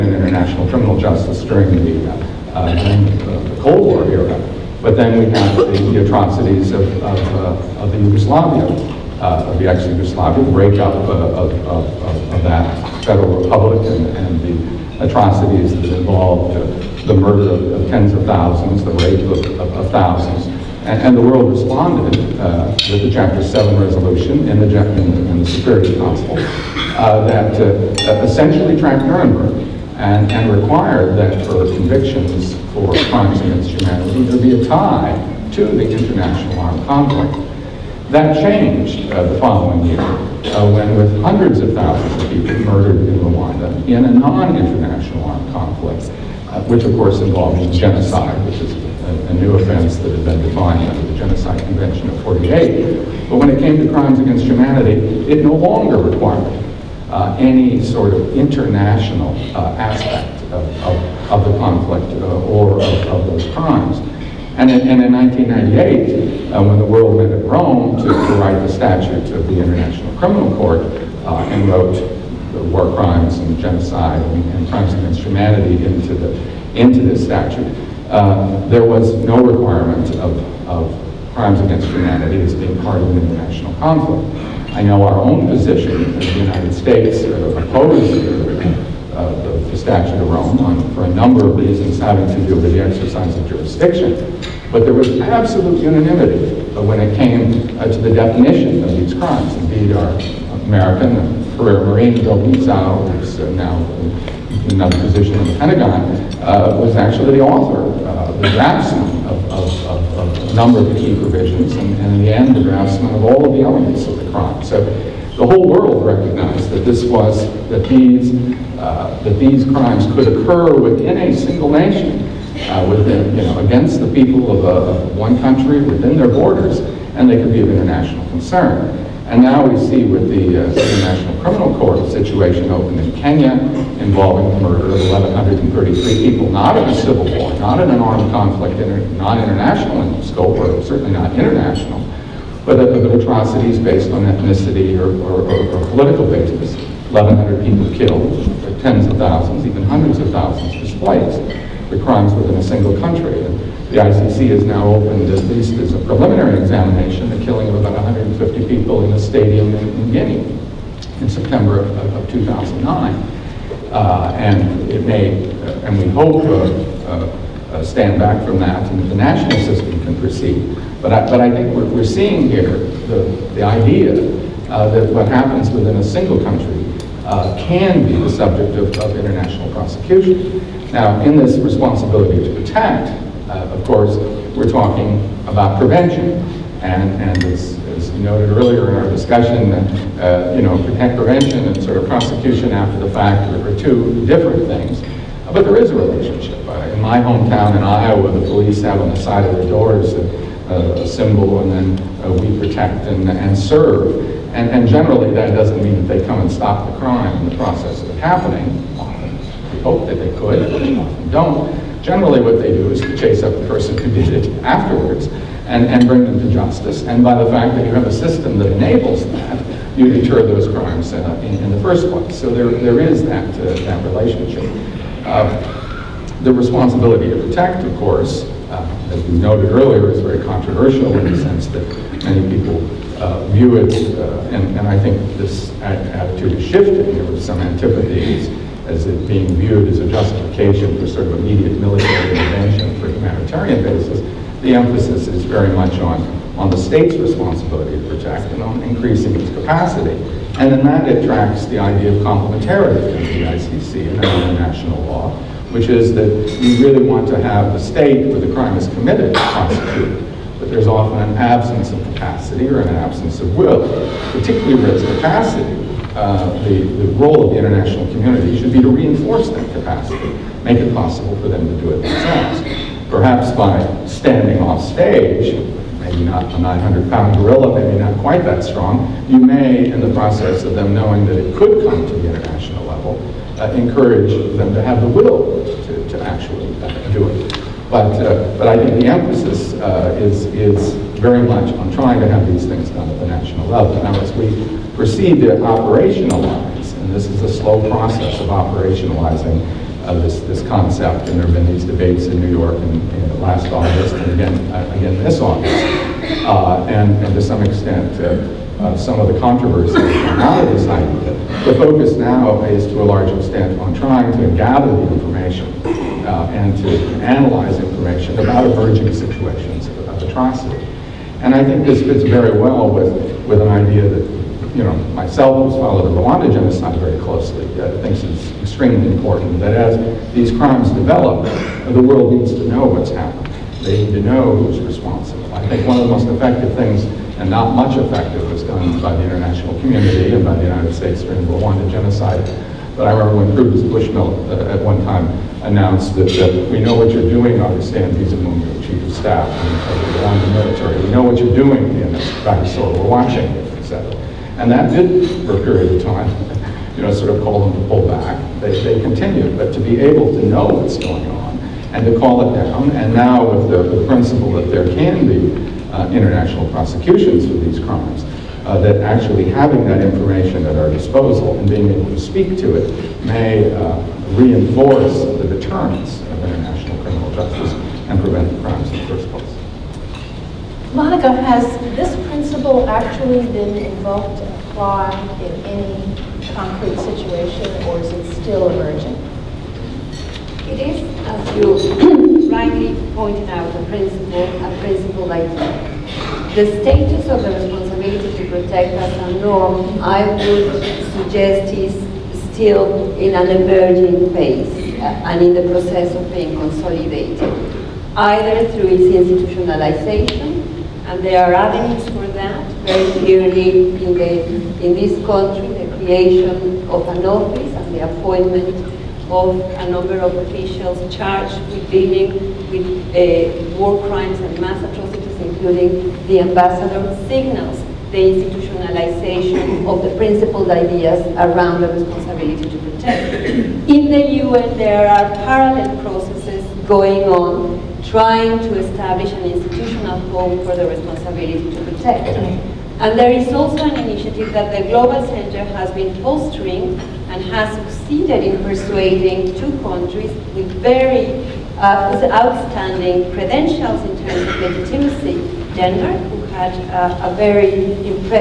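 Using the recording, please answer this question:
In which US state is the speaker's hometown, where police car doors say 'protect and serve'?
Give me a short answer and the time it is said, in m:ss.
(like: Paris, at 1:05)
Iowa, at 3:17.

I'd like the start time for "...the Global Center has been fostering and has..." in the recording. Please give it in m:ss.
7:24.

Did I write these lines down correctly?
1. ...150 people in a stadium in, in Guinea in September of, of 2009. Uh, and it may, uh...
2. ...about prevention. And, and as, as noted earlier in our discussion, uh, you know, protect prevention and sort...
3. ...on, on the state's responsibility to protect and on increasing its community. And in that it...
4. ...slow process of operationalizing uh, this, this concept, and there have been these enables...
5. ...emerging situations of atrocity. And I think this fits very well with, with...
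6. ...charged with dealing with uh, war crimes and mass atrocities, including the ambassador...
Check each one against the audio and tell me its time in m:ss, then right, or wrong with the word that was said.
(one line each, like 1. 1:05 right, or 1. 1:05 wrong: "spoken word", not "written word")
1. 2:37 right
2. 3:05 right
3. 4:05 wrong: "capacity", not "community"
4. 4:57 wrong: "debates", not "enables"
5. 5:18 right
6. 7:01 right.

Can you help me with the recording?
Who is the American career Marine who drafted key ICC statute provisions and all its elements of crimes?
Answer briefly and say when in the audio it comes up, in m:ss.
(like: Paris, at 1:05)
Bill Lietzau, at 1:42.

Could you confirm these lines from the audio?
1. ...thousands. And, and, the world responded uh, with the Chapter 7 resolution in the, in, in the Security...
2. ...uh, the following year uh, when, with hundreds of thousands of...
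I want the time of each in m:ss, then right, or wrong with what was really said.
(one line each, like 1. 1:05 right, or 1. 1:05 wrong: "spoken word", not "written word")
1. 0:19 right
2. 0:39 right.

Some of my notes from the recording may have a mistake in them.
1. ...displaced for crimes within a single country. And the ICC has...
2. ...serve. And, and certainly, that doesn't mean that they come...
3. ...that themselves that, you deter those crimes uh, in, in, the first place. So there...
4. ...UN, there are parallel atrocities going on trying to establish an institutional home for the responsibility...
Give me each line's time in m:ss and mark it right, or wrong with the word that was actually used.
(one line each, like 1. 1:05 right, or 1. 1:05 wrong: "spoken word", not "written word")
1. 2:30 right
2. 3:23 wrong: "generally", not "certainly"
3. 3:38 wrong: "enables", not "themselves"
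4. 7:14 wrong: "processes", not "atrocities".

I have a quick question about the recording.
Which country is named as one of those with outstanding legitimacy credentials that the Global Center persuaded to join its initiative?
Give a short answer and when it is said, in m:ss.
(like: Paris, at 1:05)
Denmark, at 7:35.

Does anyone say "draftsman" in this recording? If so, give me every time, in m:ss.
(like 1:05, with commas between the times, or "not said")
1:48, 1:52.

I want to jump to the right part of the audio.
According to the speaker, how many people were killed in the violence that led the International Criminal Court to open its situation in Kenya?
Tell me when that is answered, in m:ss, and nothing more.
2:15.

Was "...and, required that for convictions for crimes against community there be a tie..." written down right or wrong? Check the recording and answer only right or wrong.
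wrong.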